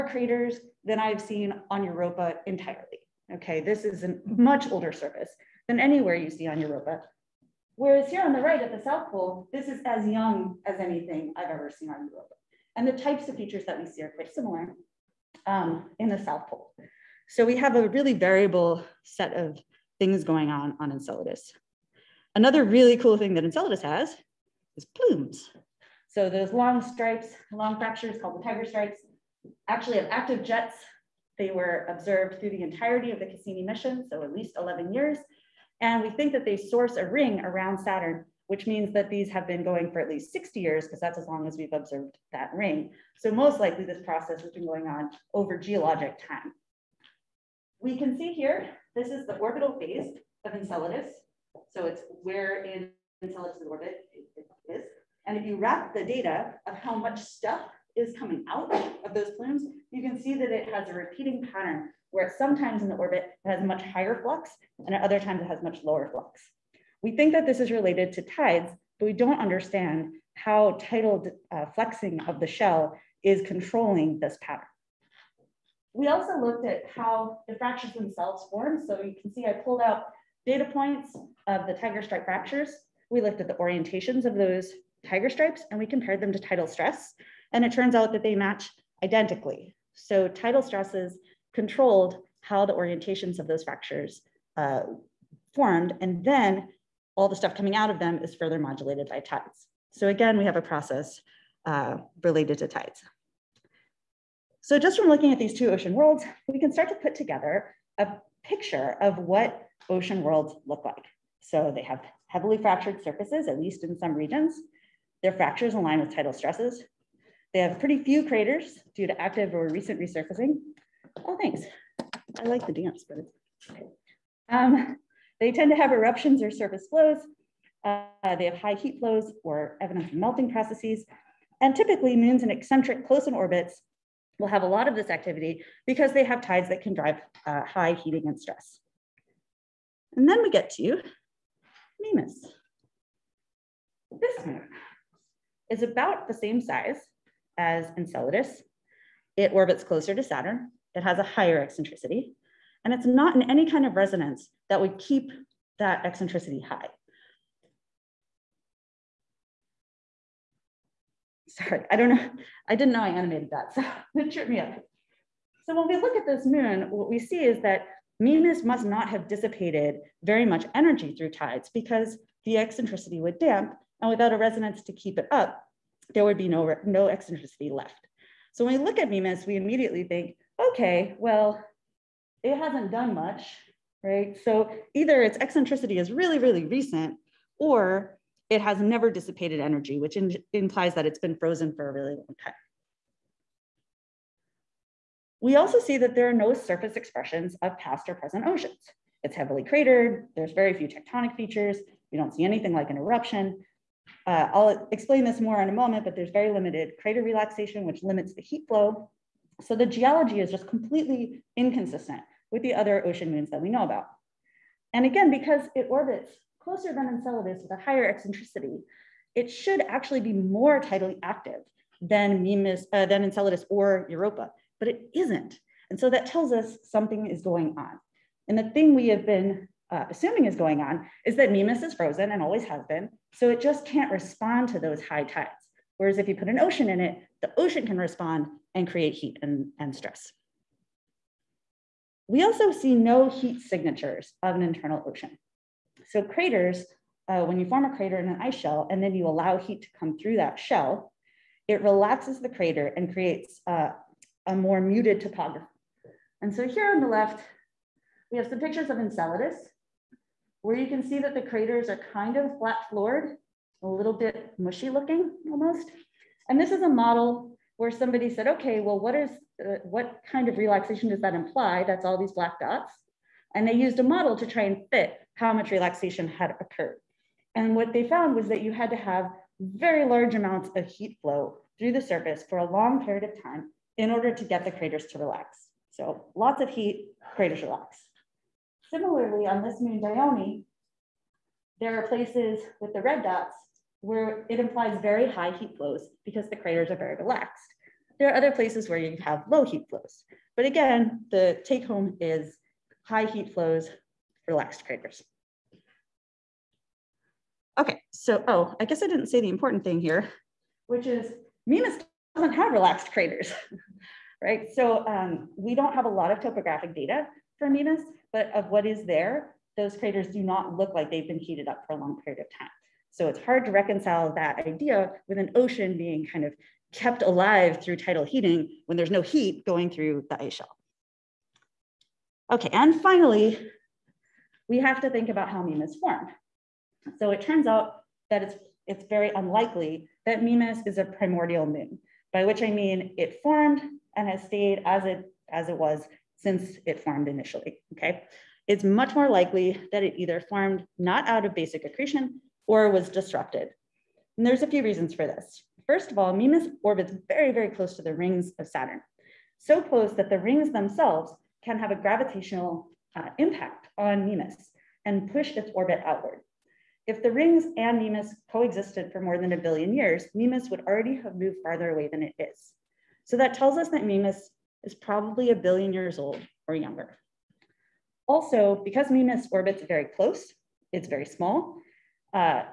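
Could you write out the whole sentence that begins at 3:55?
Whereas if you put an ocean in it, the ocean can respond and create heat and, and stress.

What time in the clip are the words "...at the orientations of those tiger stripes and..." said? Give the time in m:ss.
1:23.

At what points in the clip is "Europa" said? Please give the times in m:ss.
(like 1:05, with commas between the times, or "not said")
0:01, 0:06, 0:12, 3:44.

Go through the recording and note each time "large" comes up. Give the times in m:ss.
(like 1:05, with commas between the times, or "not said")
4:40.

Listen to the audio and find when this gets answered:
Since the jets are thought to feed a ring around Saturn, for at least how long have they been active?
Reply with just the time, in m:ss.
0:40.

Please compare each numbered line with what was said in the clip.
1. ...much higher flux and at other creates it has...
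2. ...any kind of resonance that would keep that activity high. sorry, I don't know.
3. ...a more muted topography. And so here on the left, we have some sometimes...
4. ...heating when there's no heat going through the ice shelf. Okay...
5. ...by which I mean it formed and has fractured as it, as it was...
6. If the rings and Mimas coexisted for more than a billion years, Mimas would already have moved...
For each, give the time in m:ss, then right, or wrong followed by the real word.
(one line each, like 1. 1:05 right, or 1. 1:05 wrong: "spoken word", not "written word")
1. 1:03 wrong: "times", not "creates"
2. 2:33 wrong: "eccentricity", not "activity"
3. 4:14 wrong: "pictures", not "sometimes"
4. 5:28 right
5. 5:42 wrong: "stayed", not "fractured"
6. 6:07 right.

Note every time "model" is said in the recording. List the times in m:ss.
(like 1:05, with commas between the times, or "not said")
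4:26, 4:34.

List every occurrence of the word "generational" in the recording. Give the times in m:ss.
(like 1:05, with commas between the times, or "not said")
not said.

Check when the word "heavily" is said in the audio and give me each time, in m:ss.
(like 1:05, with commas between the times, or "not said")
1:52, 3:19.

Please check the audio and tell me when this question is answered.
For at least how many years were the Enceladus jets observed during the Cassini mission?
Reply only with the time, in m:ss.
0:34.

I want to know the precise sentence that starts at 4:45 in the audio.
So lots of heat, craters relax.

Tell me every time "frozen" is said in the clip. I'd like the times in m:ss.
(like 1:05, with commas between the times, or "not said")
3:11, 3:51.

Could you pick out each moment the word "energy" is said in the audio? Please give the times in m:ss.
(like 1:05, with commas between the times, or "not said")
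2:50, 3:09.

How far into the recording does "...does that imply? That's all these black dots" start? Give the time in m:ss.
4:31.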